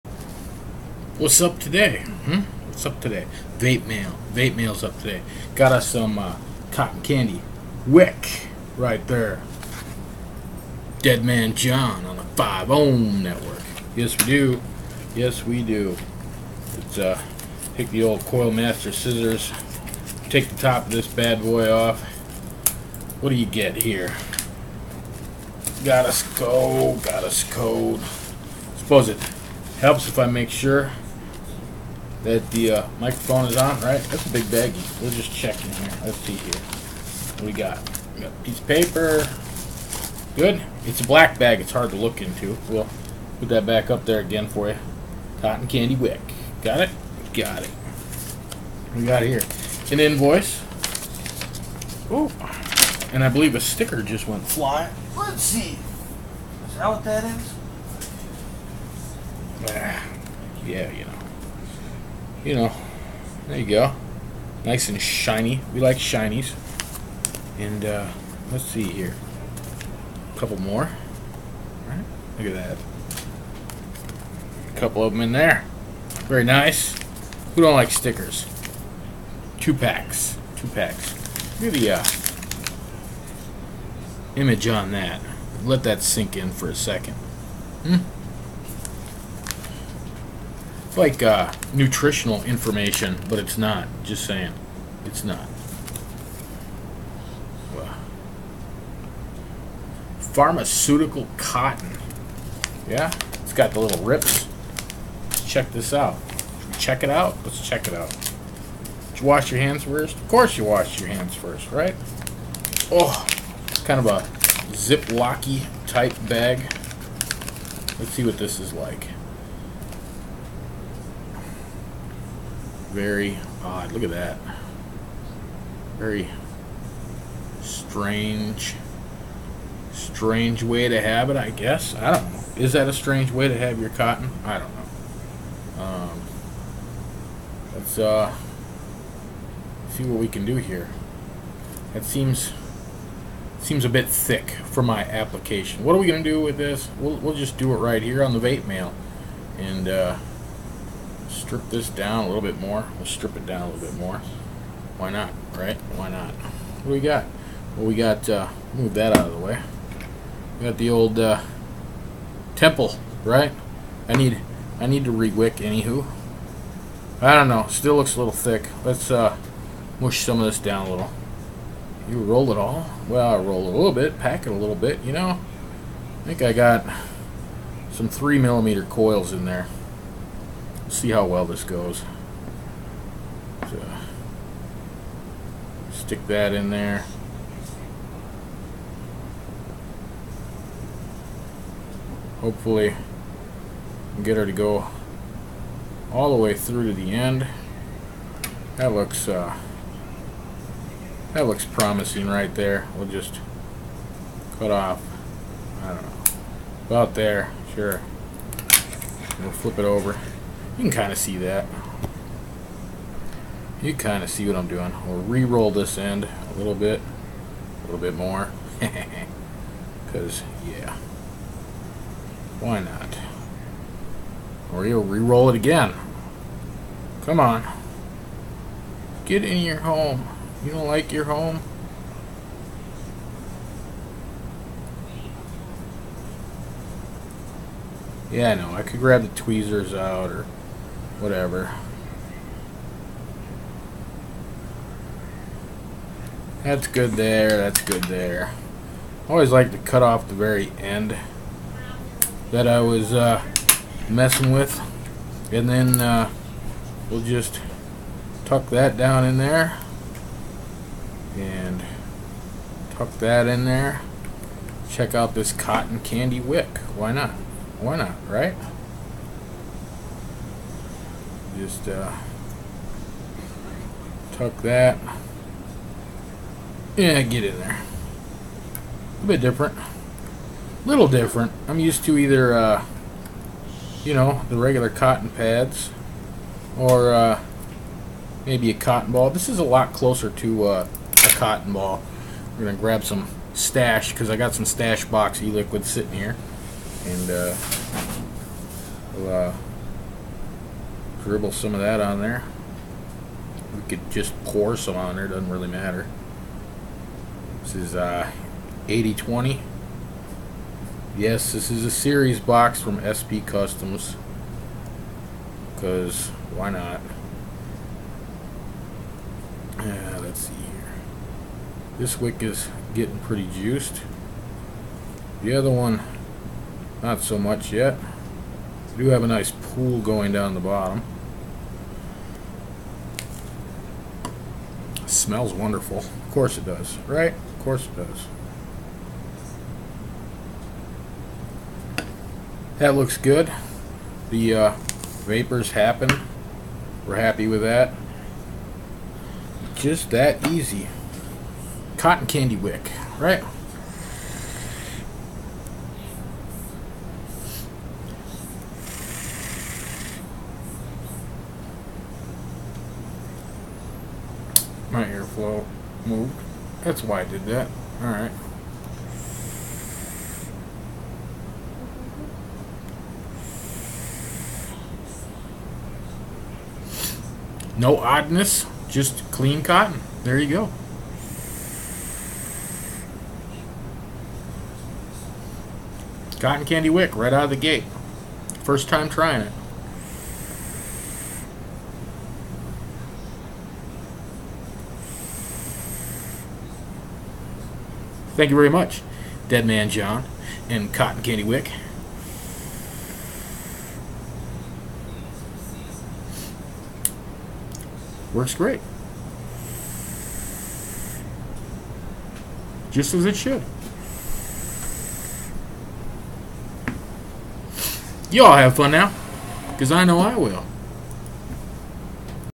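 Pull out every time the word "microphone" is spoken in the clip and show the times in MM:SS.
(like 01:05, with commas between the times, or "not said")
00:32.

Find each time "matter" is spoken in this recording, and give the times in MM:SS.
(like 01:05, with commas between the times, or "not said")
05:05.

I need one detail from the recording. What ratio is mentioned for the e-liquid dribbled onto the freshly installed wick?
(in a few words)
80/20.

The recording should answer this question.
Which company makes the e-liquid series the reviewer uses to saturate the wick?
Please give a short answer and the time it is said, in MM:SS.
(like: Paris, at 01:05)
SP Customs, at 05:13.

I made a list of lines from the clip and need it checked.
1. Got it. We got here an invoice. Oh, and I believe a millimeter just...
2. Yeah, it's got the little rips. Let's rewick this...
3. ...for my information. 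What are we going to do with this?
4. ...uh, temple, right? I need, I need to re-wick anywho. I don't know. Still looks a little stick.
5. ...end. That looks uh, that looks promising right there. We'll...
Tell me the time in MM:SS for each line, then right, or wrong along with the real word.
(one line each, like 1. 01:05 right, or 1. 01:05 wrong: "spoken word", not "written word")
1. 00:47 wrong: "sticker", not "millimeter"
2. 01:42 wrong: "check", not "rewick"
3. 02:24 wrong: "application", not "information"
4. 02:41 wrong: "thick", not "stick"
5. 03:17 right.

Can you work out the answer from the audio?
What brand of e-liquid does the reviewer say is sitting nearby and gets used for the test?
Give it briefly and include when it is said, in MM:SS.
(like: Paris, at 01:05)
Stash Box, at 04:54.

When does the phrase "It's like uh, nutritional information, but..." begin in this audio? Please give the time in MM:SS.
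01:30.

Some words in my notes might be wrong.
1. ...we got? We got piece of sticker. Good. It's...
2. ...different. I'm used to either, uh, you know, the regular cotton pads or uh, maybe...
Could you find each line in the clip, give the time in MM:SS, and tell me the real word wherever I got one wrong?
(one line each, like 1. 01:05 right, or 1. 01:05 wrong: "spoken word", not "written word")
1. 00:37 wrong: "paper", not "sticker"
2. 04:41 right.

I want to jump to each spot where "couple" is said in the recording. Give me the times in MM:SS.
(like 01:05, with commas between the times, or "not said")
01:10, 01:14.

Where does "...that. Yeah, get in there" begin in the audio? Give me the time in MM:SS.
04:34.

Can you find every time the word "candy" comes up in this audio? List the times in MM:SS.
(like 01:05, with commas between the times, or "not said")
00:07, 00:45, 04:26, 05:52, 06:26, 06:41.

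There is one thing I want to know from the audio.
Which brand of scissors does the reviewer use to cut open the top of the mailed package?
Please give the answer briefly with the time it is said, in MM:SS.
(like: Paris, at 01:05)
Coil Master, at 00:18.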